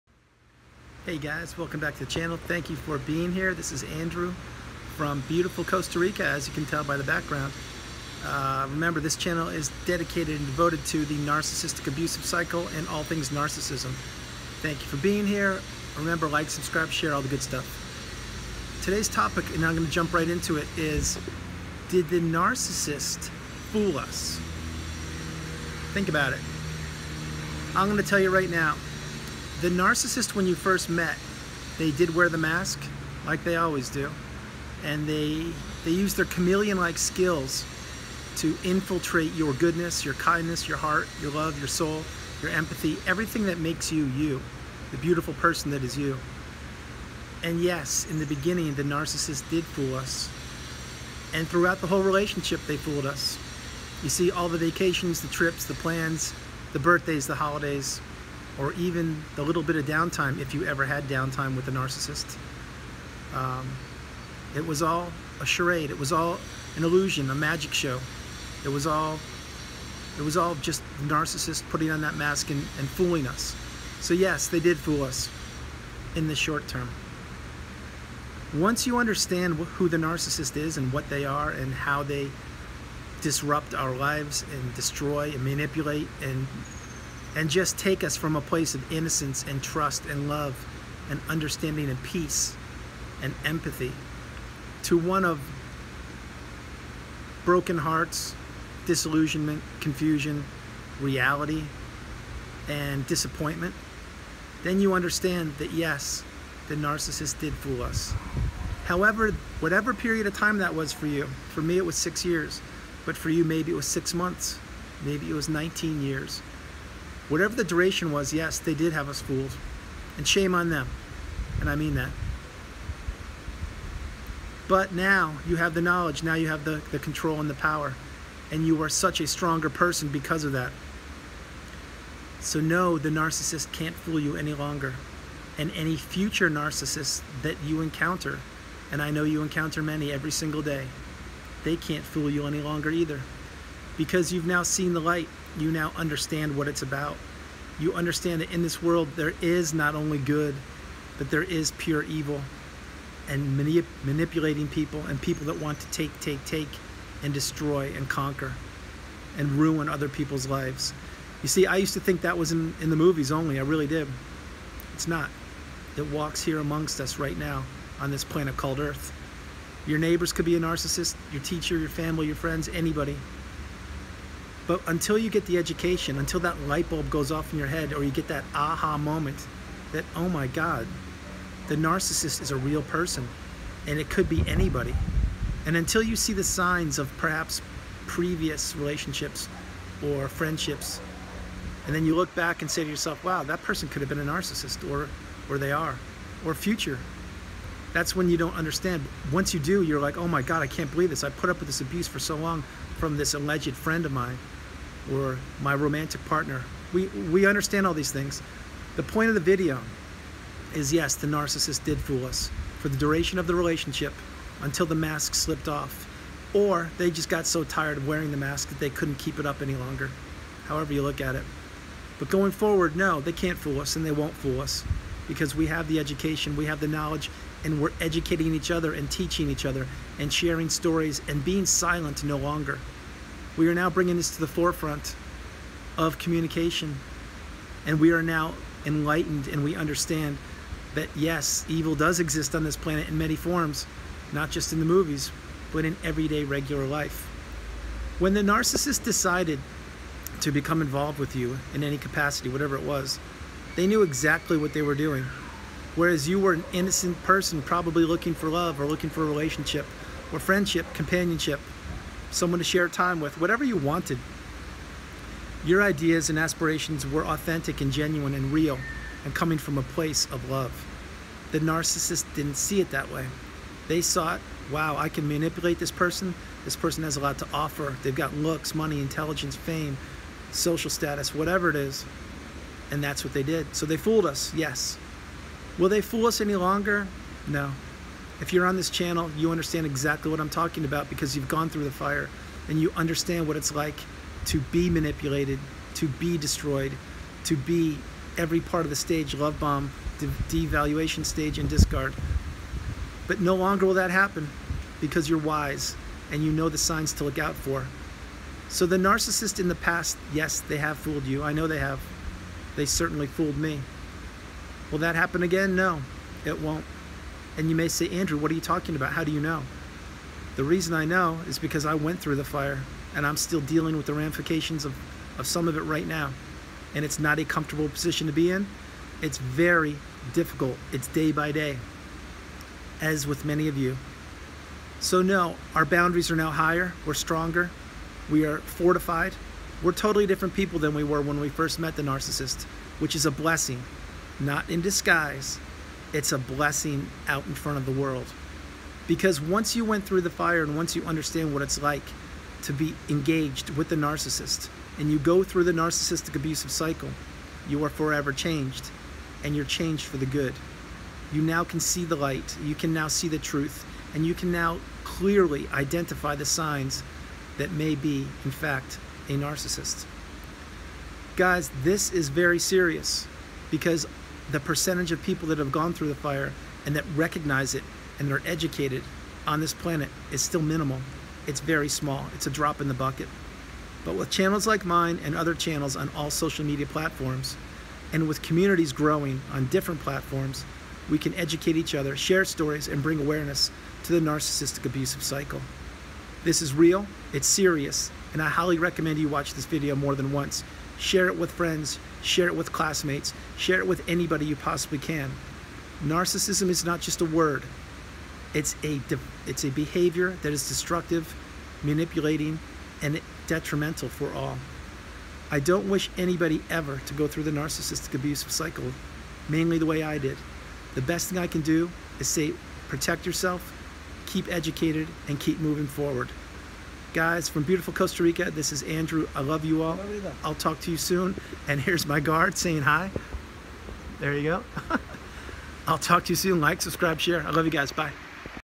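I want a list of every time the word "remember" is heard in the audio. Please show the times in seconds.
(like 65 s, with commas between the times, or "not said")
8 s, 15 s.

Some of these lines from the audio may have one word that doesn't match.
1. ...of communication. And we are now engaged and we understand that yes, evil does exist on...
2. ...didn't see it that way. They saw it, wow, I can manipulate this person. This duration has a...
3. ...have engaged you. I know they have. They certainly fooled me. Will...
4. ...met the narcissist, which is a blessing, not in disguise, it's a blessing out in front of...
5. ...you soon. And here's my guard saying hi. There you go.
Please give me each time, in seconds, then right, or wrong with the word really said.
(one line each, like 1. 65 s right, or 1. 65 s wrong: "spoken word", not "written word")
1. 235 s wrong: "enlightened", not "engaged"
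2. 272 s wrong: "person", not "duration"
3. 310 s wrong: "fooled", not "engaged"
4. 341 s right
5. 430 s right.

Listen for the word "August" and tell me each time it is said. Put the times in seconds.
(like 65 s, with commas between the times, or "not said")
not said.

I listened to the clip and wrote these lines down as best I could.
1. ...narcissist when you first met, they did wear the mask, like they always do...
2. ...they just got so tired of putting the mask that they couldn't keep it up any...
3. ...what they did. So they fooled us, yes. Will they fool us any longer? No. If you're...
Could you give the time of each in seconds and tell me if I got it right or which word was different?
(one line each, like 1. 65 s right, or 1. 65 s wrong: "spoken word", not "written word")
1. 29 s right
2. 216 s wrong: "wearing", not "putting"
3. 283 s right.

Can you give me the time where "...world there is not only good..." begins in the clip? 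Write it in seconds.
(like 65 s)
148 s.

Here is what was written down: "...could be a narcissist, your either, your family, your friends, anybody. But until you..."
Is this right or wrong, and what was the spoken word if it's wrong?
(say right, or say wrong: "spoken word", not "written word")
wrong: "teacher", not "either".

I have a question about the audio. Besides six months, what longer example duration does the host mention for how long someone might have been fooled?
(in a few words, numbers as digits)
19 years.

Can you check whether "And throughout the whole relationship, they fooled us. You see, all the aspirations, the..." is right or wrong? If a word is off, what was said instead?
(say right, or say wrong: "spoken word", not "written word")
wrong: "vacations", not "aspirations".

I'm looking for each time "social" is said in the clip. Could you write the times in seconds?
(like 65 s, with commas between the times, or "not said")
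280 s, 386 s.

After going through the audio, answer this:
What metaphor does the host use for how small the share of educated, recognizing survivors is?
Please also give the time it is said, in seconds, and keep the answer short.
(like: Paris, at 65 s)
a drop in the bucket, at 382 s.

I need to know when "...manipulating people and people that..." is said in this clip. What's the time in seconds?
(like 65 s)
154 s.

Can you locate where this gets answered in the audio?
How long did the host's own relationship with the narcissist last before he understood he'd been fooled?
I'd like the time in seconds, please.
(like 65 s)
111 s.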